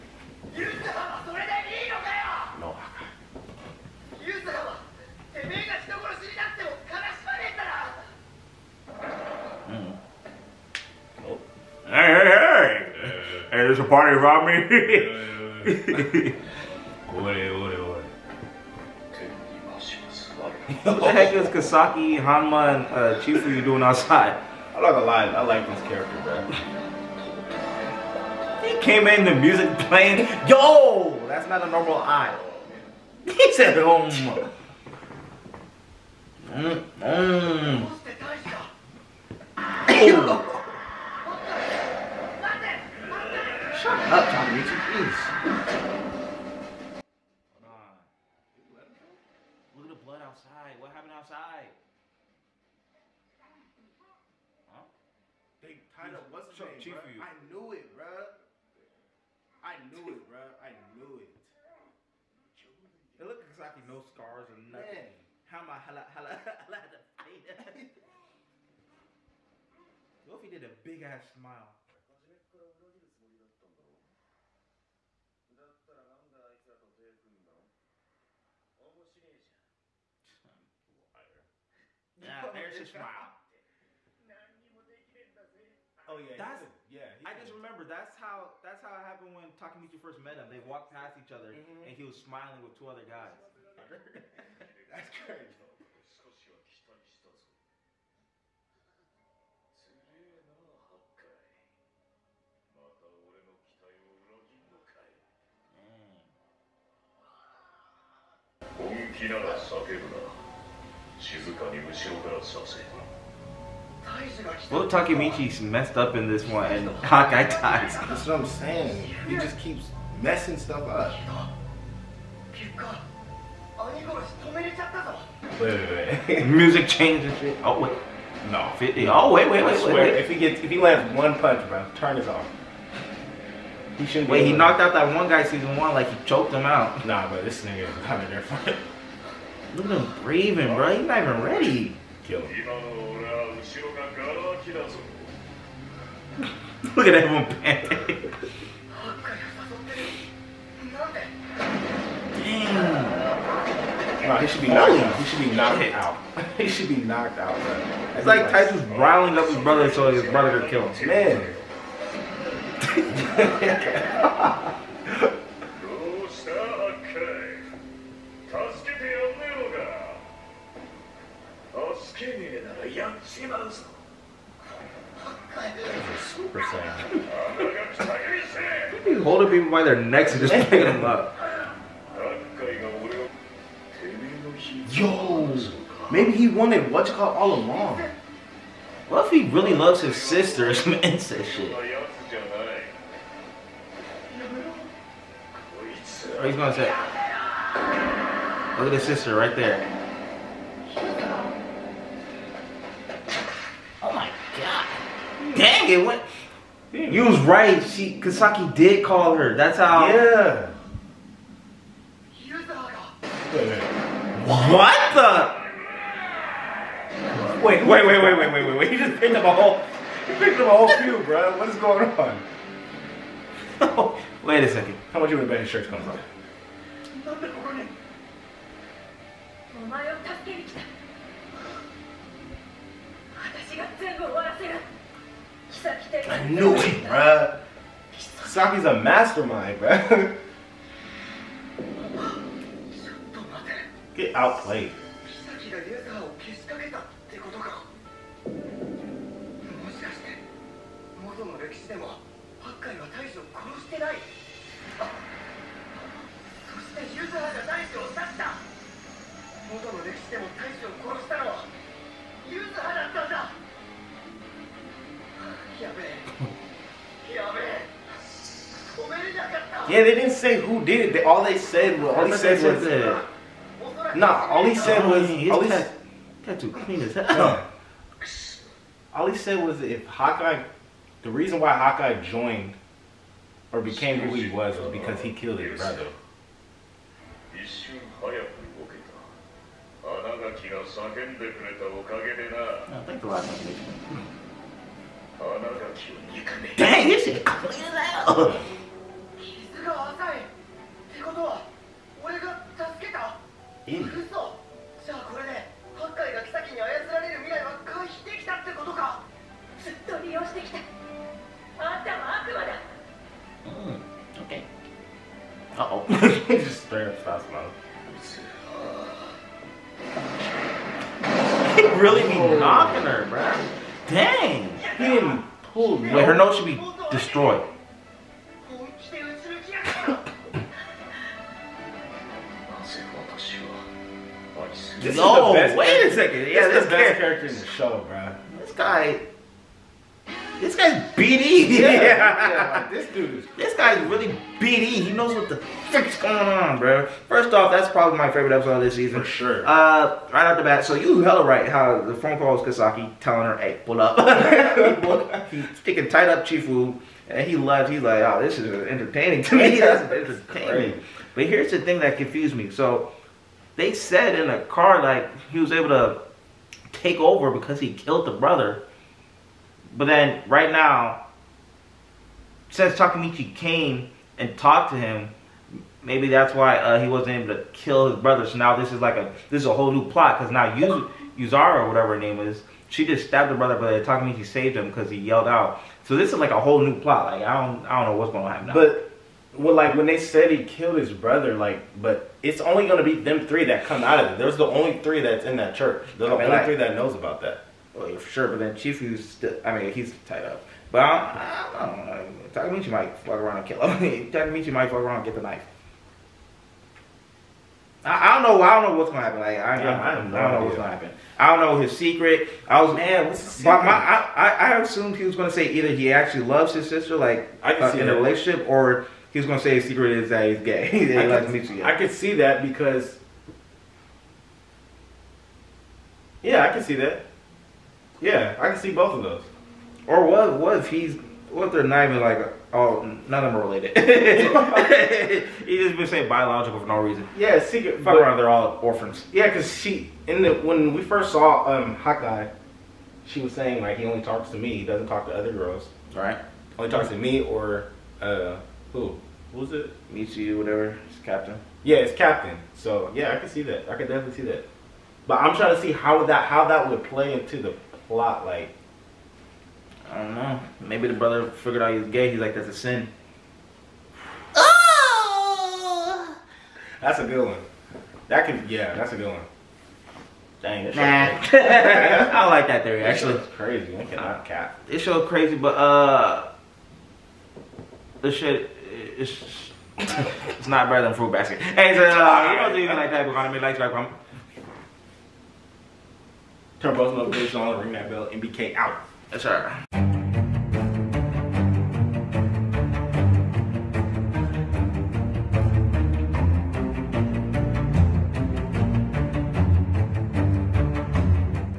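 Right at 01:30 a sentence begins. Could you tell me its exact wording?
They walked past each other mm -hmm.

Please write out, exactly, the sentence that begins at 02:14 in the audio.
Wait, he knocked out that one guy season one, like he choked him out.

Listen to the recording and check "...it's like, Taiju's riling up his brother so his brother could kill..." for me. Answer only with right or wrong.
right.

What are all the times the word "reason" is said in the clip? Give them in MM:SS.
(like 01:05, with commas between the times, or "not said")
04:41, 07:16.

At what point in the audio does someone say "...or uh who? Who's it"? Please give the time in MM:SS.
07:27.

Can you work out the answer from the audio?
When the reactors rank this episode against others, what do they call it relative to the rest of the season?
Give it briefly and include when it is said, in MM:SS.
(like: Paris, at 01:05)
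Favorite episode, at 05:48.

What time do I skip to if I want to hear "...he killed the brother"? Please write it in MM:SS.
06:07.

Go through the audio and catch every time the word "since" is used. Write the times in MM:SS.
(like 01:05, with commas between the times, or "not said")
06:12.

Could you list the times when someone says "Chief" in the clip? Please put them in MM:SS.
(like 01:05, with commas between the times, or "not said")
00:56, 05:56.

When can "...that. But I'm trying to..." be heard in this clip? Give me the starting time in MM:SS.
07:34.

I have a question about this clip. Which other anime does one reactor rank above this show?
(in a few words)
Fruit Basket.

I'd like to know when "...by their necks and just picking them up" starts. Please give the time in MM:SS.
02:59.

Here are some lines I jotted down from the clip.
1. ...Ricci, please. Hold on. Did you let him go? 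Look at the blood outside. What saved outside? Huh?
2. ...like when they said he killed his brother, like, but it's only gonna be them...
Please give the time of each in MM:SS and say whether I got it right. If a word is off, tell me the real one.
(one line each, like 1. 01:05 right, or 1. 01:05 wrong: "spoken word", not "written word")
1. 00:44 wrong: "happened", not "saved"
2. 06:29 right.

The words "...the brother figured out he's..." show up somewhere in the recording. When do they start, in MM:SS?
07:41.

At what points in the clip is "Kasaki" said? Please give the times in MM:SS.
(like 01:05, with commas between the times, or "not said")
00:21, 03:28, 05:52.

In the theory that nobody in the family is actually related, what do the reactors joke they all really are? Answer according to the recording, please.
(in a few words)
Orphans.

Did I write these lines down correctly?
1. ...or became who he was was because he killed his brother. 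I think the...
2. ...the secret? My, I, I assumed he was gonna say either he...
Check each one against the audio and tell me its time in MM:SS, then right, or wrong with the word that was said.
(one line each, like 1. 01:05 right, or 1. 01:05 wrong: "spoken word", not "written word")
1. 04:43 right
2. 06:53 right.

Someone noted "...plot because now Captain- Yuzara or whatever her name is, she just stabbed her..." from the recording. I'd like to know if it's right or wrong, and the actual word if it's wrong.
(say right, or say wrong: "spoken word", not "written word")
wrong: "Yuz", not "Captain".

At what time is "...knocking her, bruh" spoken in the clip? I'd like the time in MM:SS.
05:22.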